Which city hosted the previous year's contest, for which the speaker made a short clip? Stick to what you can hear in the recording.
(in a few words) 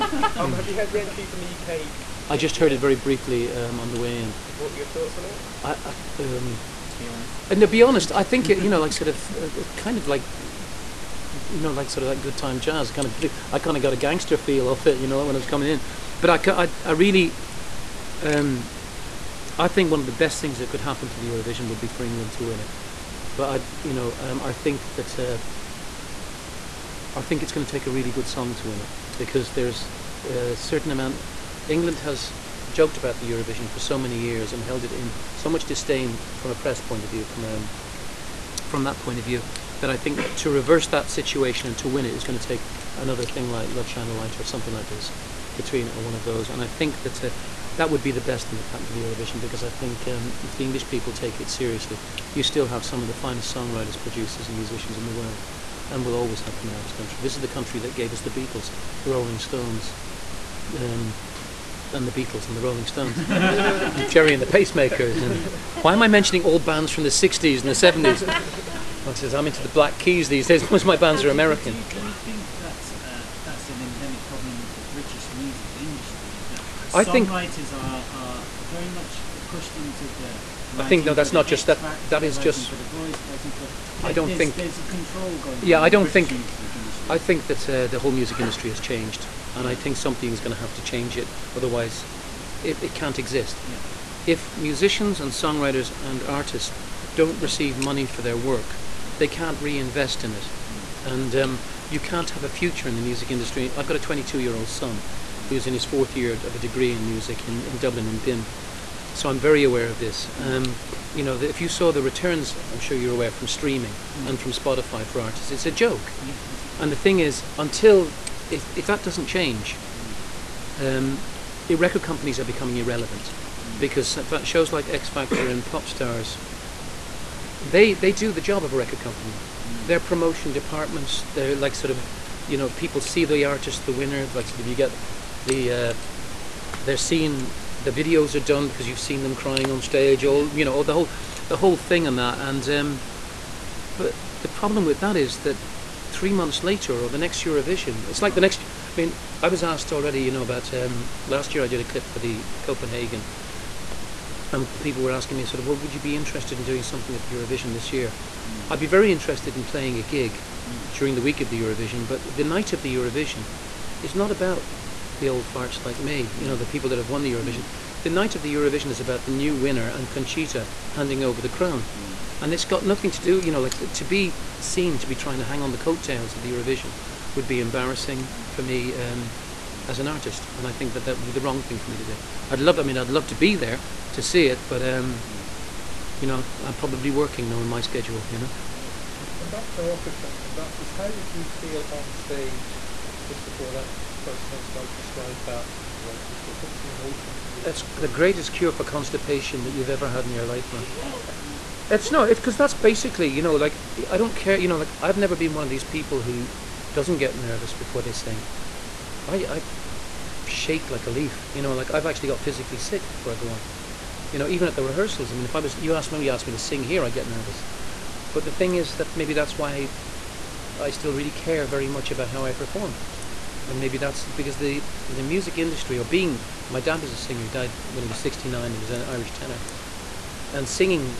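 Copenhagen.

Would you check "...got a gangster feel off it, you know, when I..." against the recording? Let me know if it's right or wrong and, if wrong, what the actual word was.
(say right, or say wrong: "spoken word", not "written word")
right.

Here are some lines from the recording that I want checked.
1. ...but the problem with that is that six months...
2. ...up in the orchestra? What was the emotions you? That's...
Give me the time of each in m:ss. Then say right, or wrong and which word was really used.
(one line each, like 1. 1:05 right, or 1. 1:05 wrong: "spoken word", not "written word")
1. 2:23 wrong: "three", not "six"
2. 3:15 right.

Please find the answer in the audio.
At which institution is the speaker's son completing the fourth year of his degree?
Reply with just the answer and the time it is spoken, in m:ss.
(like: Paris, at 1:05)
BIMM, at 1:48.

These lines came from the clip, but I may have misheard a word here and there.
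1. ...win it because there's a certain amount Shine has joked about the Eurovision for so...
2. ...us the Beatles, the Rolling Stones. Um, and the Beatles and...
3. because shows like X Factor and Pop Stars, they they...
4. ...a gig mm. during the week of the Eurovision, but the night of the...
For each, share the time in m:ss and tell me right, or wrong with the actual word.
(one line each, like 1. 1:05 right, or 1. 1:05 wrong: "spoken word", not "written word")
1. 0:28 wrong: "England", not "Shine"
2. 0:58 right
3. 2:03 right
4. 2:39 right.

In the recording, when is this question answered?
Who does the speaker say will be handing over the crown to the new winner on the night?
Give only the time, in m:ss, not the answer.
2:50.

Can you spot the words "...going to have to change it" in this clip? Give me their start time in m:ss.
1:30.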